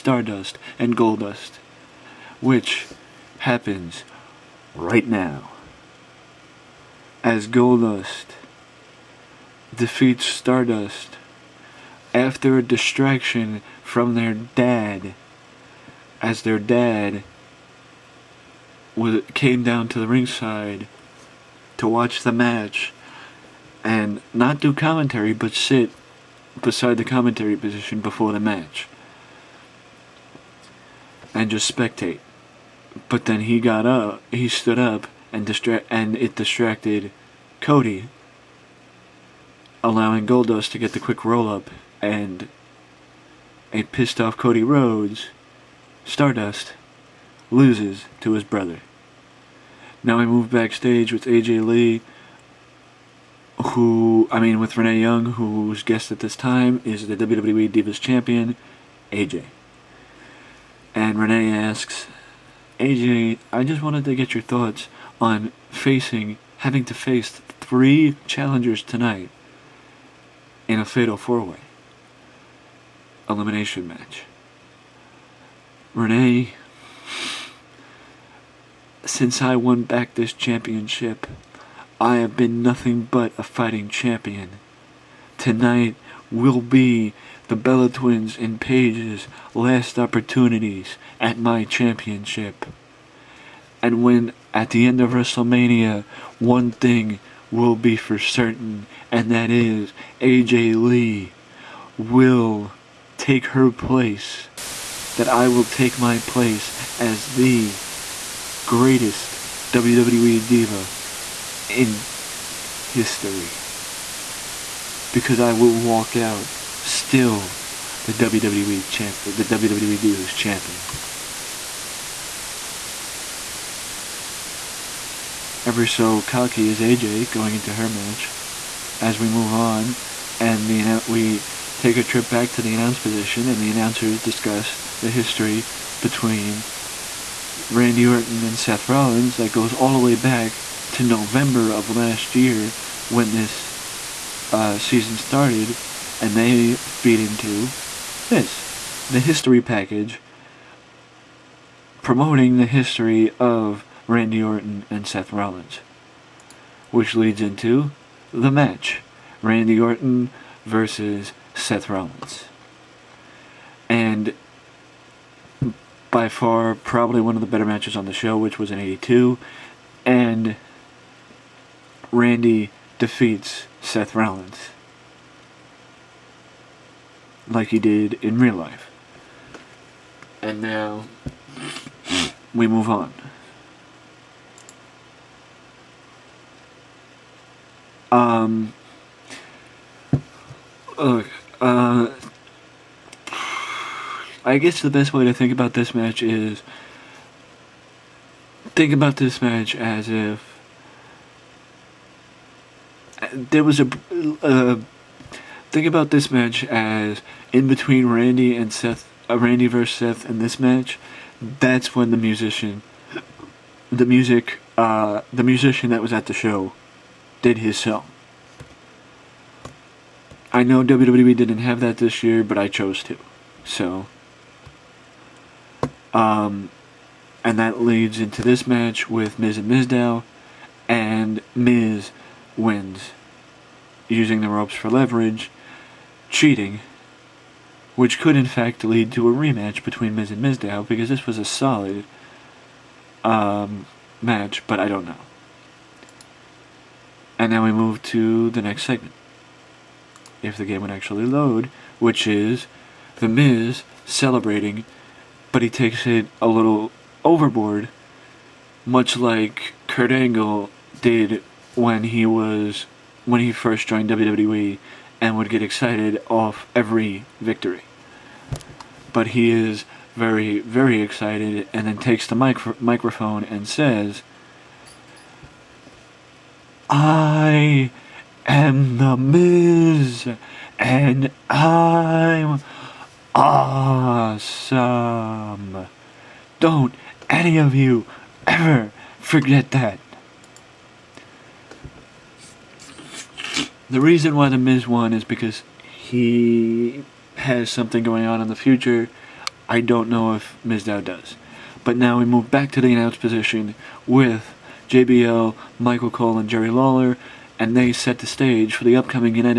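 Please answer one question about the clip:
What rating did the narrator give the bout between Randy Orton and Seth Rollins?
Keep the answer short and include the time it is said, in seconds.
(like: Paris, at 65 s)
82, at 168 s.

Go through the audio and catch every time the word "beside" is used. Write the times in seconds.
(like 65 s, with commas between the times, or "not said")
26 s.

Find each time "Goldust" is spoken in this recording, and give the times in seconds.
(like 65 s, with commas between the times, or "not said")
0 s, 7 s, 40 s.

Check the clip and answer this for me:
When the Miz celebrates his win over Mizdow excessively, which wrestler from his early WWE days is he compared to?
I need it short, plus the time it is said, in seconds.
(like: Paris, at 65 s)
Kurt Angle, at 259 s.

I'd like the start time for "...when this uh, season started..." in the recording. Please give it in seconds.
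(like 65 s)
143 s.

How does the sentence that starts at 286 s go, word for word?
Don't any of you ever forget that.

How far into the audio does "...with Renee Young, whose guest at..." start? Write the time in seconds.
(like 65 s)
54 s.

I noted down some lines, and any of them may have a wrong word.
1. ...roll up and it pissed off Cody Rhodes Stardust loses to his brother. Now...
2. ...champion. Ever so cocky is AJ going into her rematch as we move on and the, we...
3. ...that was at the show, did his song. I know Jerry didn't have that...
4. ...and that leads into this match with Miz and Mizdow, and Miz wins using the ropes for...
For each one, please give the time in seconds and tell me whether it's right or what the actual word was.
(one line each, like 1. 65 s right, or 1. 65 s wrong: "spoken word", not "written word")
1. 41 s right
2. 120 s wrong: "match", not "rematch"
3. 215 s wrong: "WWE", not "Jerry"
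4. 227 s right.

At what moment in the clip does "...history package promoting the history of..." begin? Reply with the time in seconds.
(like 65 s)
149 s.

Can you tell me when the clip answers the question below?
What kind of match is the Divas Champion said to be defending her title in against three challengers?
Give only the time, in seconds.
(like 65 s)
70 s.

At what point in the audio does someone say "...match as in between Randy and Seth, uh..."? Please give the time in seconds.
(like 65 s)
206 s.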